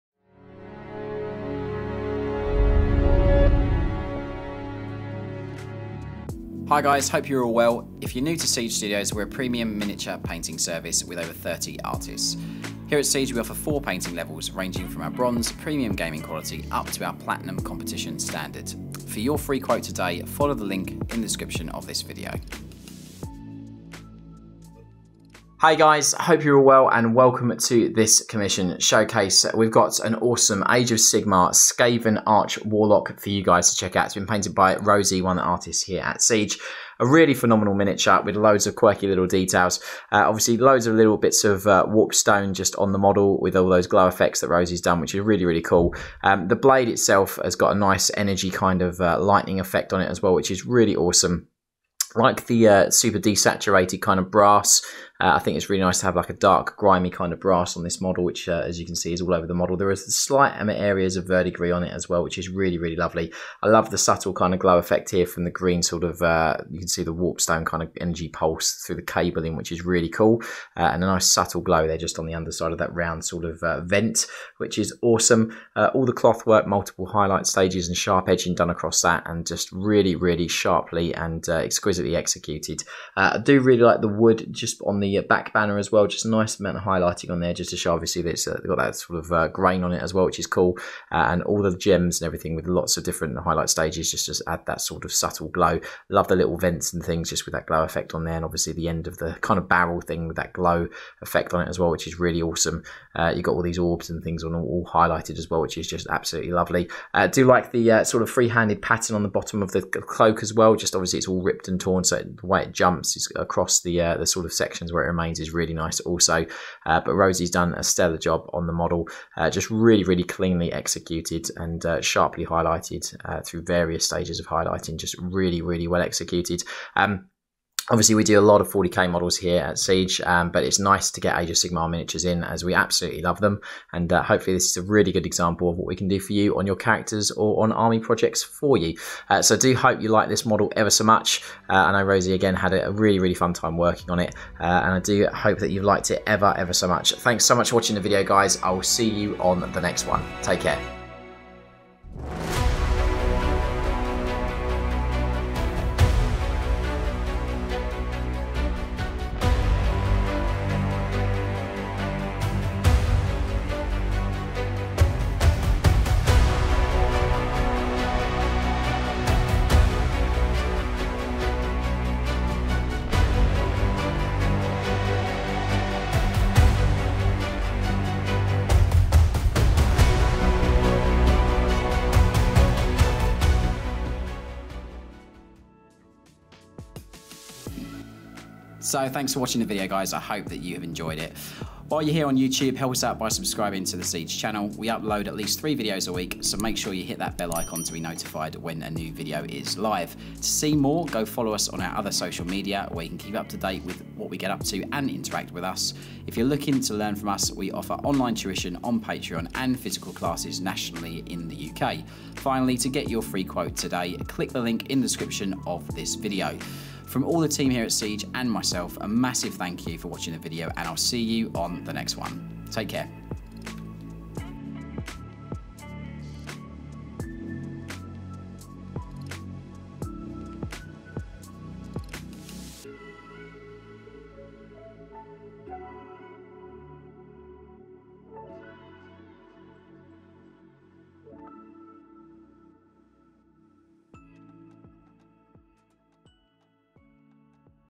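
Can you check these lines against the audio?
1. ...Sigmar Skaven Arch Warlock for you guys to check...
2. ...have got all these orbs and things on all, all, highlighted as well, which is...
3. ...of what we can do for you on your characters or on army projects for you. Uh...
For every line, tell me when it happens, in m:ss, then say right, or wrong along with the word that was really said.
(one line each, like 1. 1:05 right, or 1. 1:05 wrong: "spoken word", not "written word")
1. 0:30 right
2. 1:43 right
3. 2:15 right.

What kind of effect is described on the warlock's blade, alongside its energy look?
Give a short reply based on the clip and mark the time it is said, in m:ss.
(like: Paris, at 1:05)
lightning effect, at 0:49.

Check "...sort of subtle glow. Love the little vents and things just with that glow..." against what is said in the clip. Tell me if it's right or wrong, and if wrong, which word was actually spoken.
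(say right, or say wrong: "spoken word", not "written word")
right.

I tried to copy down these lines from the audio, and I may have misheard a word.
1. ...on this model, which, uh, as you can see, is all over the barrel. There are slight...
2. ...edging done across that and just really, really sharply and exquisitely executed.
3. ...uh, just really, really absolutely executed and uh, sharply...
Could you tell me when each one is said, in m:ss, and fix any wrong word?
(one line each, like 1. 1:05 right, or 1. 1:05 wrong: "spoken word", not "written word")
1. 0:57 wrong: "model", not "barrel"
2. 1:18 right
3. 1:59 wrong: "cleanly", not "absolutely".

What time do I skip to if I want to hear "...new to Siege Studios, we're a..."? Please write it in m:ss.
0:08.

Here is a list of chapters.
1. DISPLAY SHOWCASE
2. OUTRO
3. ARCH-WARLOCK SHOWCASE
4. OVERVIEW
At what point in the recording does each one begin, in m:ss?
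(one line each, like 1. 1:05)
1. 2:32
2. 3:08
3. 0:38
4. 0:25.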